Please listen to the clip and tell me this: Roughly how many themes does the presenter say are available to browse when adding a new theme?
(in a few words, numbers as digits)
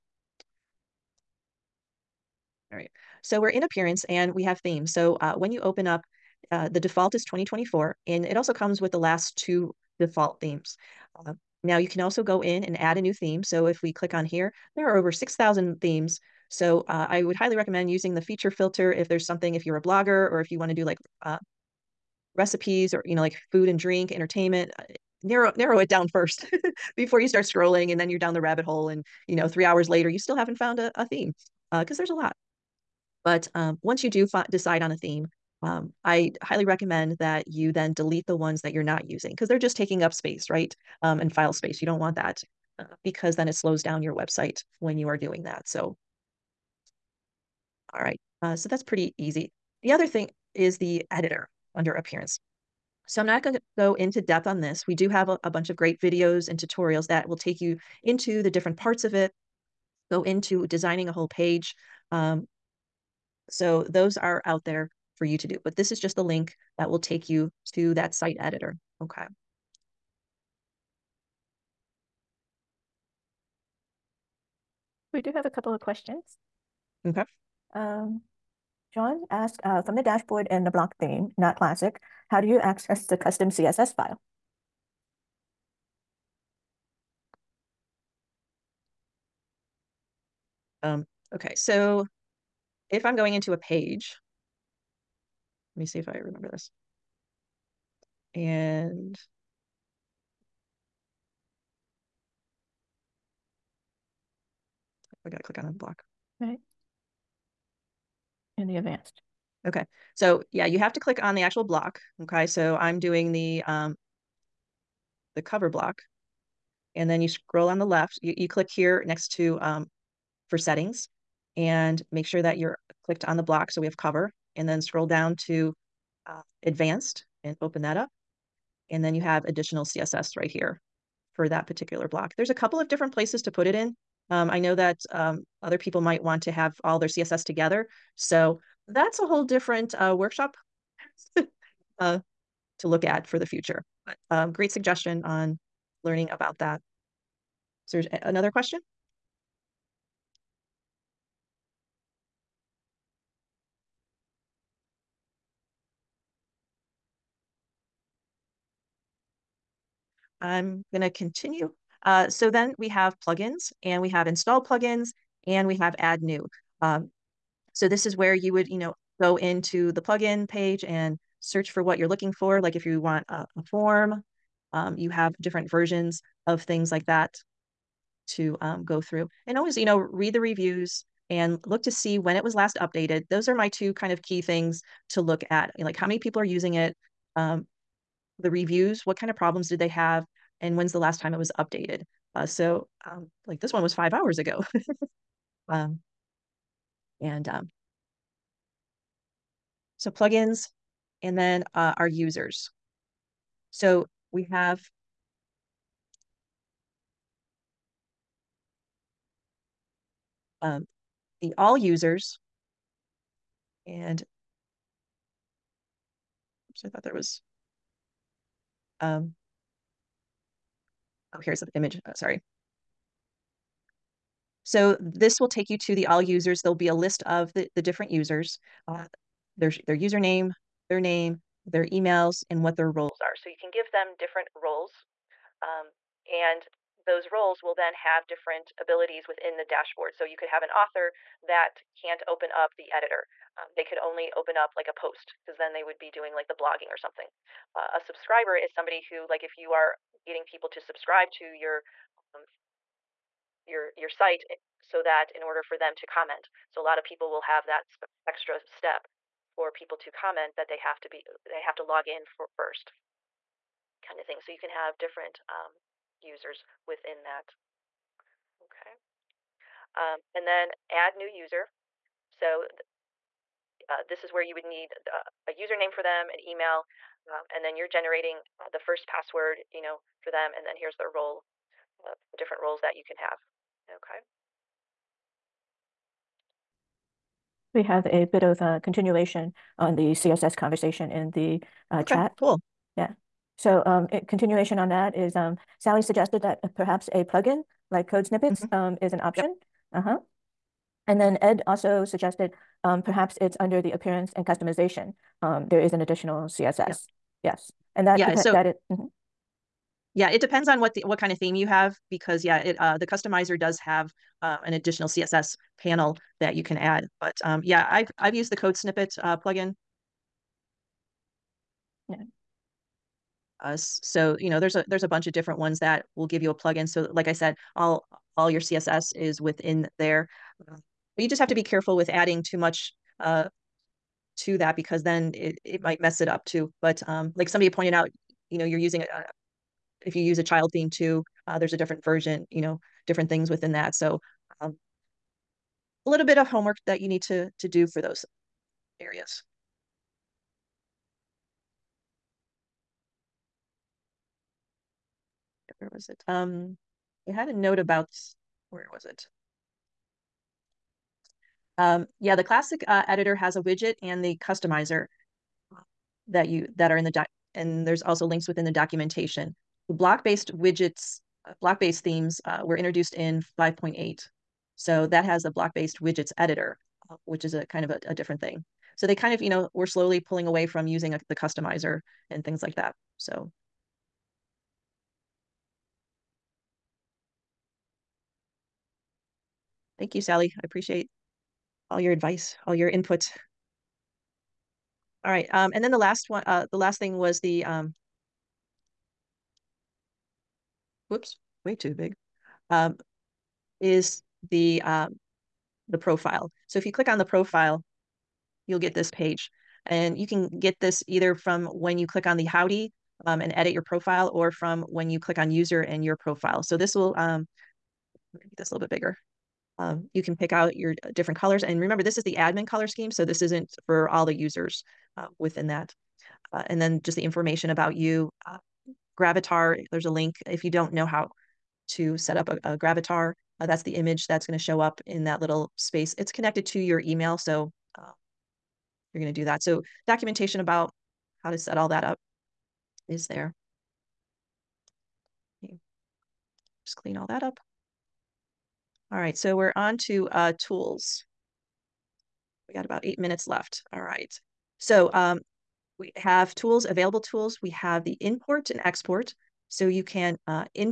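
over 6,000.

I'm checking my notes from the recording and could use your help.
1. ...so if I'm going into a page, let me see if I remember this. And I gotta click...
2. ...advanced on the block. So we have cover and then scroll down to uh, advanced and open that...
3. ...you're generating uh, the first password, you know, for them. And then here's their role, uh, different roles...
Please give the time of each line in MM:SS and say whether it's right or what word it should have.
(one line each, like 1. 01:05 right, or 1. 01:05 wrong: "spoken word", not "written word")
1. 01:31 right
2. 02:03 wrong: "clicked", not "advanced"
3. 04:37 right.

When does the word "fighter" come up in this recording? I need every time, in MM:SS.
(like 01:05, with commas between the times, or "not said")
not said.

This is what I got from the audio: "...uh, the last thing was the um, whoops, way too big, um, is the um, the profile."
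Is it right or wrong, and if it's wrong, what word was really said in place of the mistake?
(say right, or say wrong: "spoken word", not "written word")
right.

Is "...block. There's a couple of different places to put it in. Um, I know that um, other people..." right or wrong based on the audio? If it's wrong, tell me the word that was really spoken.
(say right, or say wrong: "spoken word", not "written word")
right.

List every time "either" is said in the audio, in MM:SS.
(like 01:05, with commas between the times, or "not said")
06:51.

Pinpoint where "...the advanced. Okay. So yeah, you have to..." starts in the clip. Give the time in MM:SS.
01:48.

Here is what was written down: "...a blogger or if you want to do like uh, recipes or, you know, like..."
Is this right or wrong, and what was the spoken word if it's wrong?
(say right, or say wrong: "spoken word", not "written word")
right.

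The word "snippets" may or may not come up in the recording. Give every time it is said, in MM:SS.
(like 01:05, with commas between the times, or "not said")
04:58, 05:18.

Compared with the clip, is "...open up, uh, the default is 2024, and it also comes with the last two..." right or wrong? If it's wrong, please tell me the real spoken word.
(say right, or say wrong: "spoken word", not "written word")
right.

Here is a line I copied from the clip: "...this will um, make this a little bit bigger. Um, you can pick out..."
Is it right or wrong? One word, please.
right.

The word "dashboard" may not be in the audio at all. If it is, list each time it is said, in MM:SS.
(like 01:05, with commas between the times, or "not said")
01:20, 03:59.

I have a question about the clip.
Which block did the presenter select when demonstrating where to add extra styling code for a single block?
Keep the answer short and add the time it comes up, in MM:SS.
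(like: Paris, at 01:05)
cover block, at 01:55.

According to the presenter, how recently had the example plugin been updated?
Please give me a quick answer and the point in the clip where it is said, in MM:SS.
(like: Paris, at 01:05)
five hours ago, at 03:13.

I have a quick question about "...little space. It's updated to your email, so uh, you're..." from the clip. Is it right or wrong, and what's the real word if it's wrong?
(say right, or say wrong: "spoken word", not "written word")
wrong: "connected", not "updated".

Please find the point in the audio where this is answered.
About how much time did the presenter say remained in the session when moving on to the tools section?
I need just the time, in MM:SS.
07:32.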